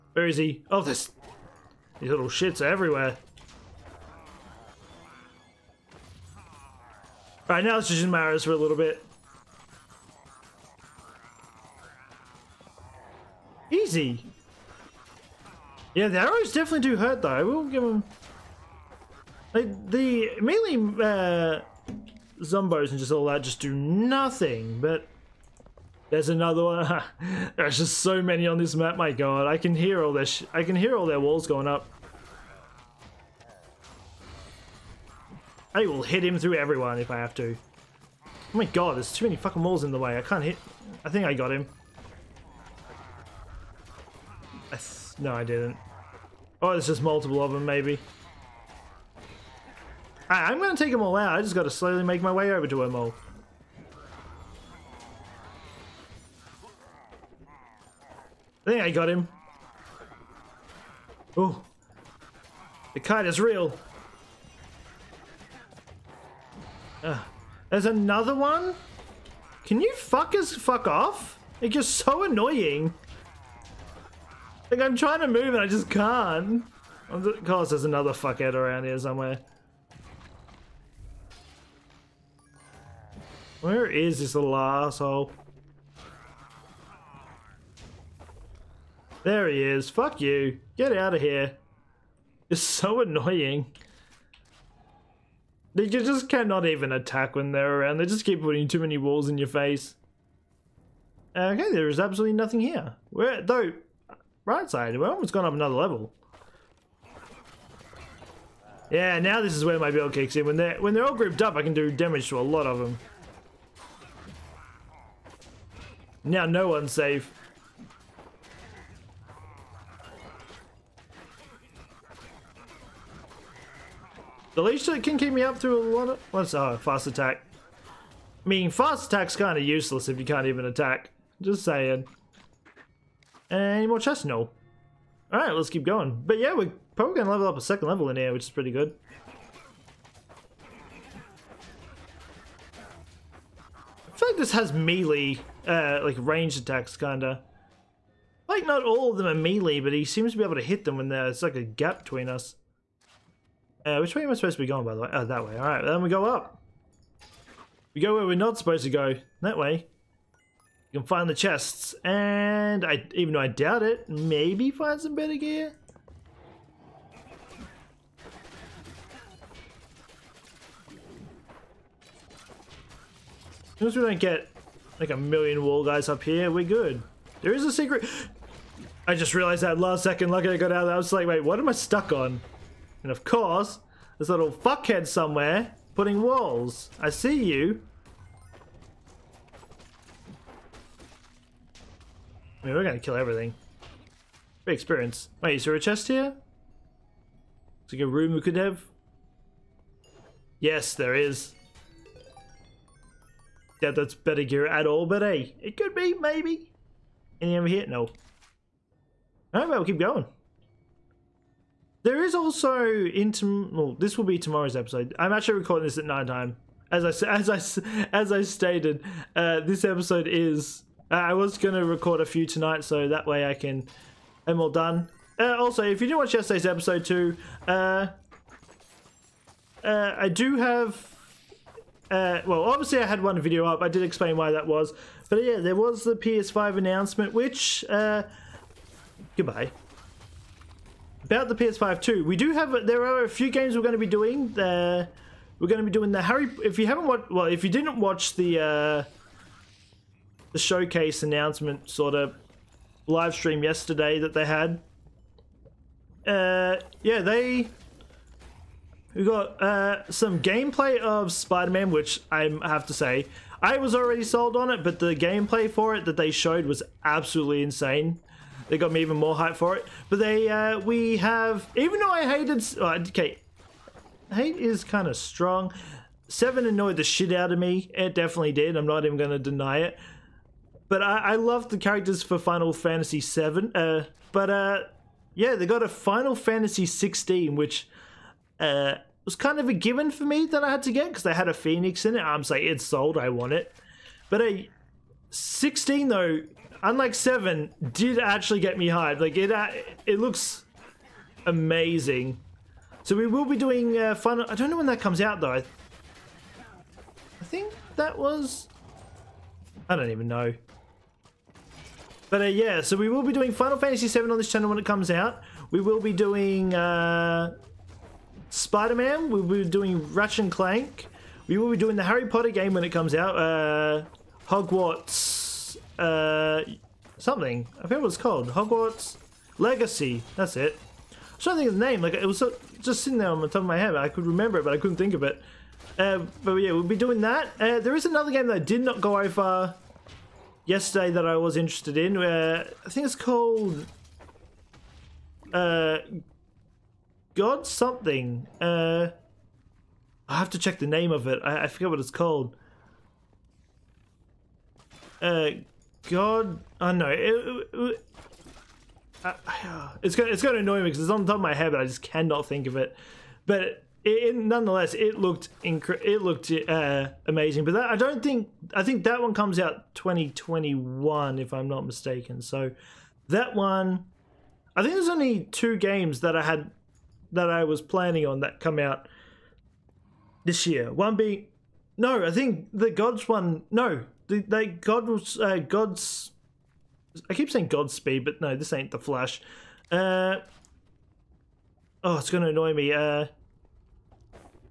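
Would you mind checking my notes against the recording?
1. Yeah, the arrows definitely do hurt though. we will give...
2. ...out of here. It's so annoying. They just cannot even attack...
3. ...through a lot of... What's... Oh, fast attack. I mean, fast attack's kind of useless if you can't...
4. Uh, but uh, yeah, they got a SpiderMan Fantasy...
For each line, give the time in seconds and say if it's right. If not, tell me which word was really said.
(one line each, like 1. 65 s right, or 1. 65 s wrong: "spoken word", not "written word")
1. 13 s right
2. 90 s right
3. 125 s right
4. 283 s wrong: "Final", not "SpiderMan".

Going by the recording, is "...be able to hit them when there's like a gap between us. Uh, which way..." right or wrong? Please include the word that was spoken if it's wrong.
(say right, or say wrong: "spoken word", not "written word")
right.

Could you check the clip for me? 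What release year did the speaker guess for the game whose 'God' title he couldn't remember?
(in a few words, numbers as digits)
2021.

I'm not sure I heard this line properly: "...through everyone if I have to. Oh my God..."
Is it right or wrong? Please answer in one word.
right.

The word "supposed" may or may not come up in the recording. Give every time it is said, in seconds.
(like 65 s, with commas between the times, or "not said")
154 s, 158 s.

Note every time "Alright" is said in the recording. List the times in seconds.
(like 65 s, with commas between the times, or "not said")
135 s, 155 s, 209 s.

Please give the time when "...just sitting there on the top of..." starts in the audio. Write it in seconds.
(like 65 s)
332 s.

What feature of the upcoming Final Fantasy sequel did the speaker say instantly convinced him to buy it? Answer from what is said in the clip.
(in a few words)
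a Phoenix.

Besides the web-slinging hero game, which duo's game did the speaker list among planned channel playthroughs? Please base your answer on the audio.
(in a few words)
Ratchet and Clank.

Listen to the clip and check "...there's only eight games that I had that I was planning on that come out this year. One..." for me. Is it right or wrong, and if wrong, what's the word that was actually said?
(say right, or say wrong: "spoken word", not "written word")
wrong: "two", not "eight".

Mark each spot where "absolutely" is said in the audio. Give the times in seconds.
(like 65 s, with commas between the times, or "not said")
101 s, 267 s.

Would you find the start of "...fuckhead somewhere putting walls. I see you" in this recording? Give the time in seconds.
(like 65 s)
184 s.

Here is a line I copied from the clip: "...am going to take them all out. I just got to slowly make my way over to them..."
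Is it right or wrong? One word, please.
right.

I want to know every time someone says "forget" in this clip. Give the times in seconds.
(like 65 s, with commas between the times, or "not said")
327 s, 351 s.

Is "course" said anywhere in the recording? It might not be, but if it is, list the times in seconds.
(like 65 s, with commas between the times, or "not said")
77 s, 183 s.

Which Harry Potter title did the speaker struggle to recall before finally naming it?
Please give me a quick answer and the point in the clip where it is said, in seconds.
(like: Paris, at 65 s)
Hogwarts Legacy, at 328 s.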